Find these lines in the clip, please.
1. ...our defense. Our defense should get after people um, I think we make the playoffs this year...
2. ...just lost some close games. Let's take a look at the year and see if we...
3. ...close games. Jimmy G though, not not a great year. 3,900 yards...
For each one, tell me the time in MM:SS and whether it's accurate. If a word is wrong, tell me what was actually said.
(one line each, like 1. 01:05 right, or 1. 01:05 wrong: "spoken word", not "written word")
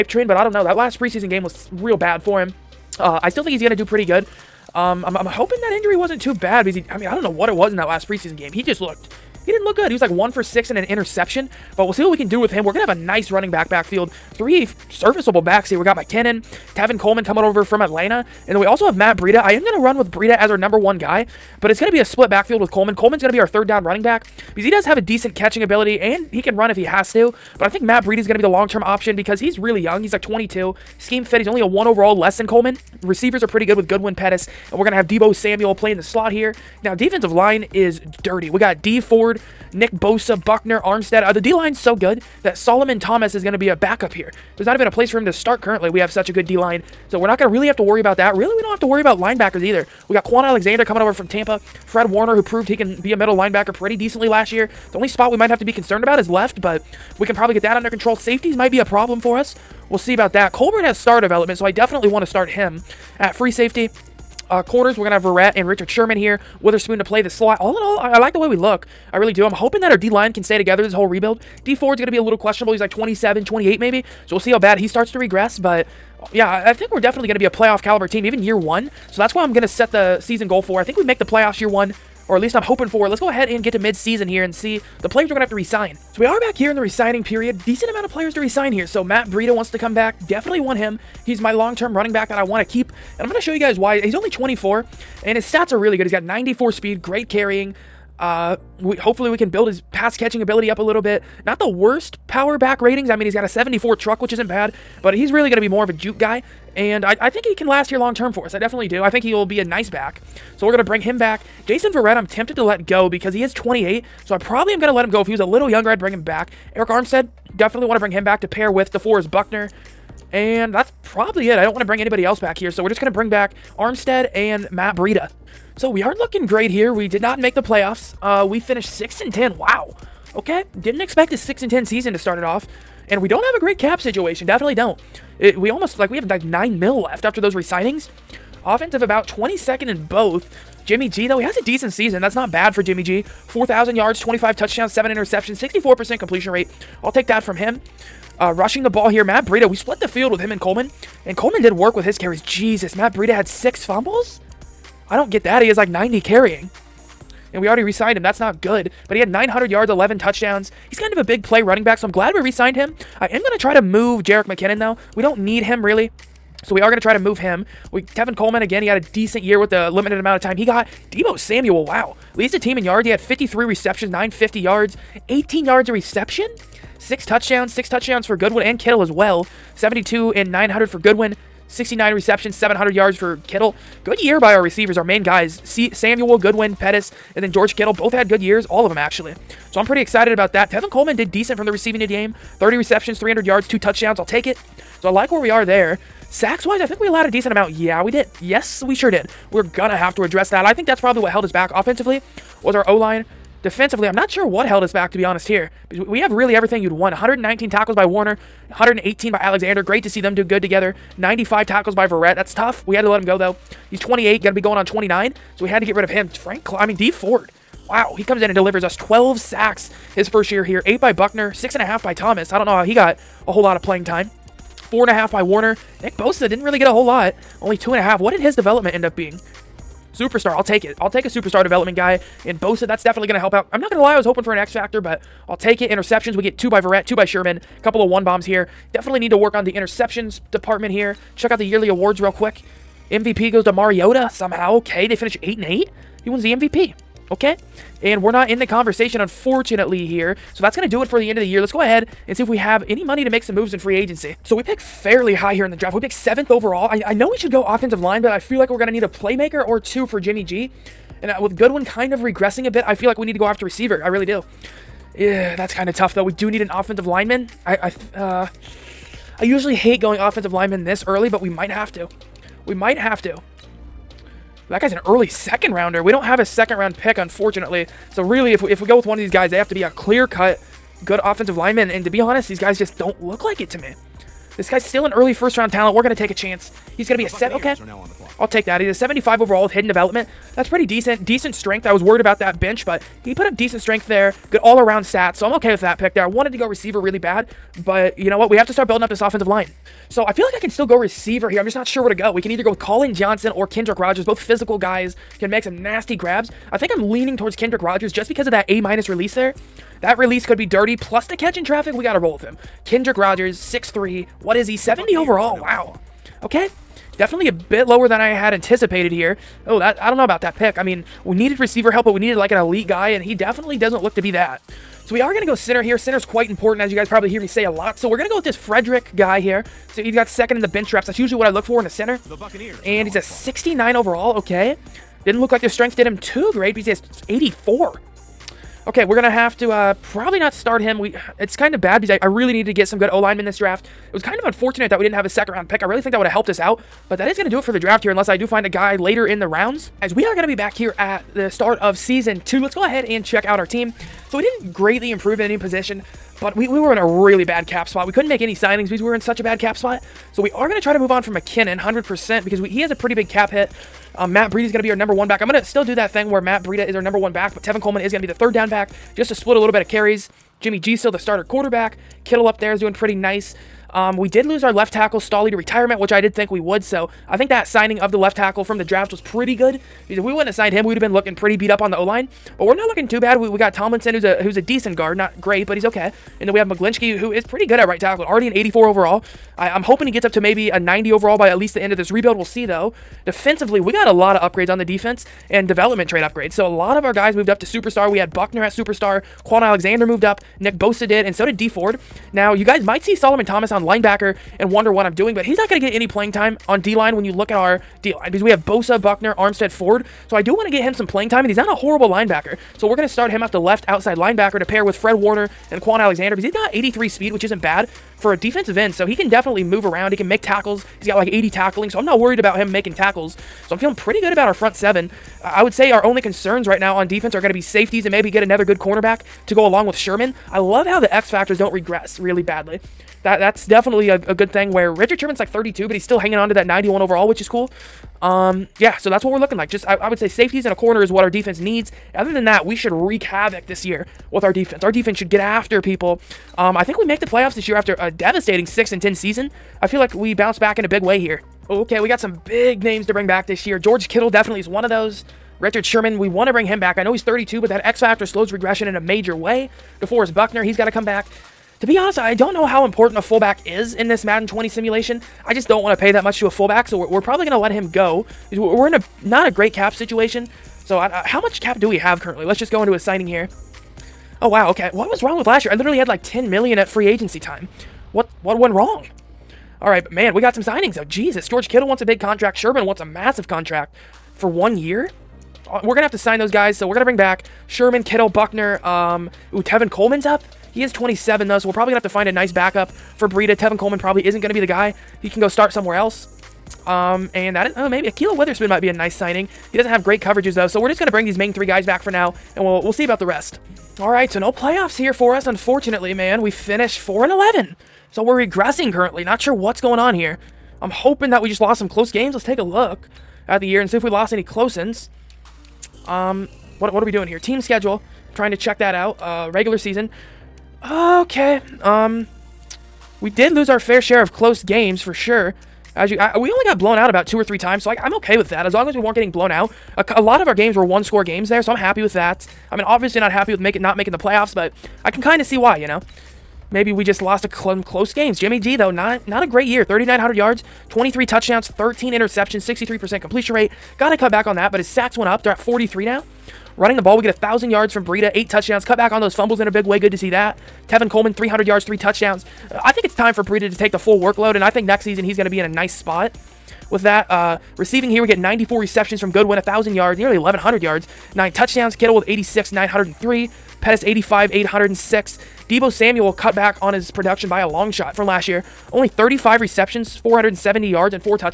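1. 07:24 right
2. 08:31 right
3. 08:57 right.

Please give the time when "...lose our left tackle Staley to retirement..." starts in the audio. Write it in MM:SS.
06:14.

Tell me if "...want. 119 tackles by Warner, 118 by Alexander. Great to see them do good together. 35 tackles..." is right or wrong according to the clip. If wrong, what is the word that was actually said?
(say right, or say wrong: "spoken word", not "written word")
wrong: "95", not "35".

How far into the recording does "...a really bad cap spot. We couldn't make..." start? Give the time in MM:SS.
05:56.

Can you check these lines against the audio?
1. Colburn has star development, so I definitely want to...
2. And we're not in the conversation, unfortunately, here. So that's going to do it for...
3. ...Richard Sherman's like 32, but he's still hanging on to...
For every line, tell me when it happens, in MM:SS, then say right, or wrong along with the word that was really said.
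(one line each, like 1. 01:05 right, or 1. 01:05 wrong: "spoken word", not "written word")
1. 01:00 right
2. 04:08 right
3. 07:14 right.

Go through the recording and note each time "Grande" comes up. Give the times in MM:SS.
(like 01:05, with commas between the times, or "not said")
not said.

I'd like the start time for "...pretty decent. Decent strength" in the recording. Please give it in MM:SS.
04:50.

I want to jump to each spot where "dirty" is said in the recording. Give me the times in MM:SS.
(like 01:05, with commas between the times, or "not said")
00:38, 05:10.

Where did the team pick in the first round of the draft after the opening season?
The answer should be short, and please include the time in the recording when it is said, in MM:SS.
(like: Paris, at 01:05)
7th overall, at 04:16.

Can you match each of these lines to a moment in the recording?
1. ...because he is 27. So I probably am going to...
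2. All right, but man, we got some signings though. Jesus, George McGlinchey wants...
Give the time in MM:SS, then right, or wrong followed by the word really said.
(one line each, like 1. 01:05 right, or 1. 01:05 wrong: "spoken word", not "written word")
1. 01:53 wrong: "28", not "27"
2. 07:59 wrong: "Kittle", not "McGlinchey".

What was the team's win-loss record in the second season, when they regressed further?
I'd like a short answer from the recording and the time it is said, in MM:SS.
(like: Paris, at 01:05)
4 and 11, at 08:26.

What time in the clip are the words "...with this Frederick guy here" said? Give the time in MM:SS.
05:28.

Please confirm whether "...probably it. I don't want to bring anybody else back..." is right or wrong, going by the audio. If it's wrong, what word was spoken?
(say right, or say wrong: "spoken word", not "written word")
right.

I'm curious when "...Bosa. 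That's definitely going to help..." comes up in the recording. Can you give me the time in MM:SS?
03:52.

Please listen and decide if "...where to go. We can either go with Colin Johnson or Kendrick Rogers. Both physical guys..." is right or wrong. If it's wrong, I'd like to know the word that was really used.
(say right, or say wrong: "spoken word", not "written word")
right.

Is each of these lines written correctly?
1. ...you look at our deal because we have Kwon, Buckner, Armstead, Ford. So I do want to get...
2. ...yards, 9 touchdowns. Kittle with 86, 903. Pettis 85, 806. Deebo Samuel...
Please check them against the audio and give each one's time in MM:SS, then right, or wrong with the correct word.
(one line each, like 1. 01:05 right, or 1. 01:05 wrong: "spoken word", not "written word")
1. 06:47 wrong: "Bosa", not "Kwon"
2. 09:20 right.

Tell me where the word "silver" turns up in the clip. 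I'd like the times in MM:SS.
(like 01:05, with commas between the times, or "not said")
not said.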